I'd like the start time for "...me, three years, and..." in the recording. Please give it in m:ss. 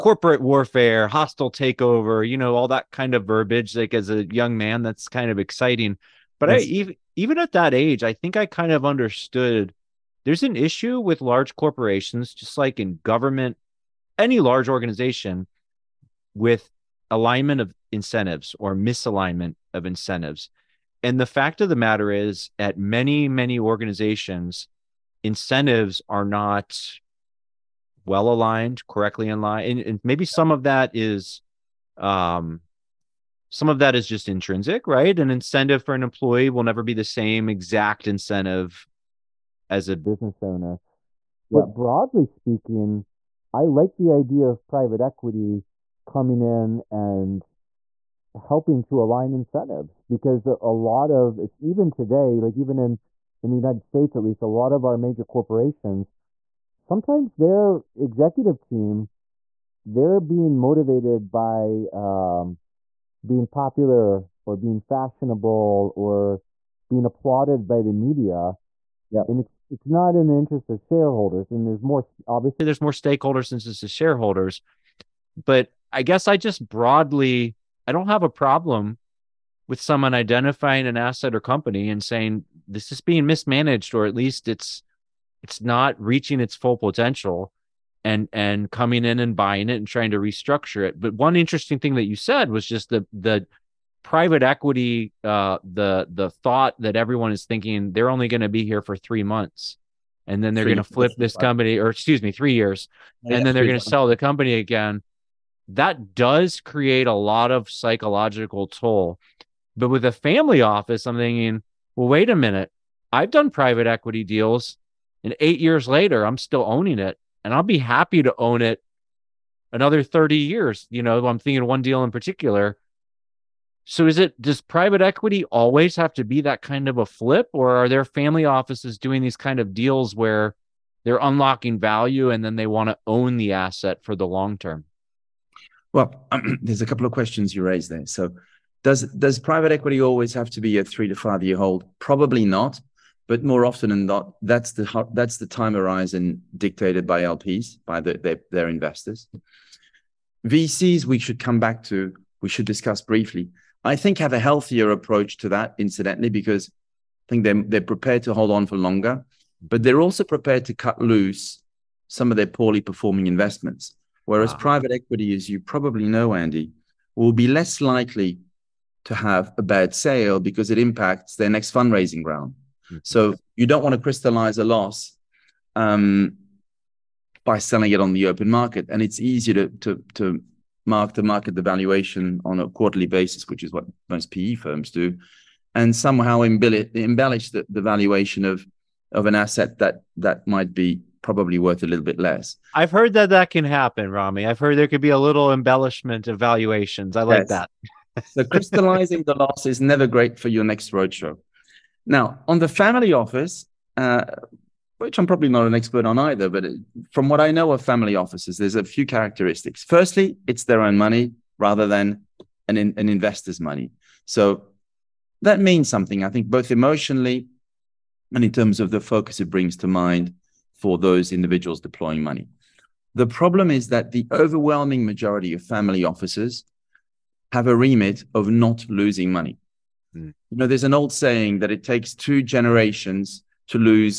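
1:42.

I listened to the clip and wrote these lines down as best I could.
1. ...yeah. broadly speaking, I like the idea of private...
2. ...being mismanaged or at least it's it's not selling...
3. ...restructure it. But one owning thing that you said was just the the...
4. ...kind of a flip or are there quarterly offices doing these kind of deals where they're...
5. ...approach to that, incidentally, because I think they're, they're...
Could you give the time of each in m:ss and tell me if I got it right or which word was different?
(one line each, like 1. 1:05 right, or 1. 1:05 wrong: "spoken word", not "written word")
1. 0:41 right
2. 1:23 wrong: "reaching", not "selling"
3. 1:30 wrong: "interesting", not "owning"
4. 2:06 wrong: "family", not "quarterly"
5. 2:34 right.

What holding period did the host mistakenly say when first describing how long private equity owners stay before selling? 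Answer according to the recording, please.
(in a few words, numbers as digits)
3 months.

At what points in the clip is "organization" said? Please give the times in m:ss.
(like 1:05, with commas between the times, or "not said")
0:14, 0:23.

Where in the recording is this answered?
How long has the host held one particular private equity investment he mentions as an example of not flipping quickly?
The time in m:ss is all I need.
1:55.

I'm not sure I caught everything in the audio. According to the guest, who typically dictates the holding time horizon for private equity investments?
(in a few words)
LPs.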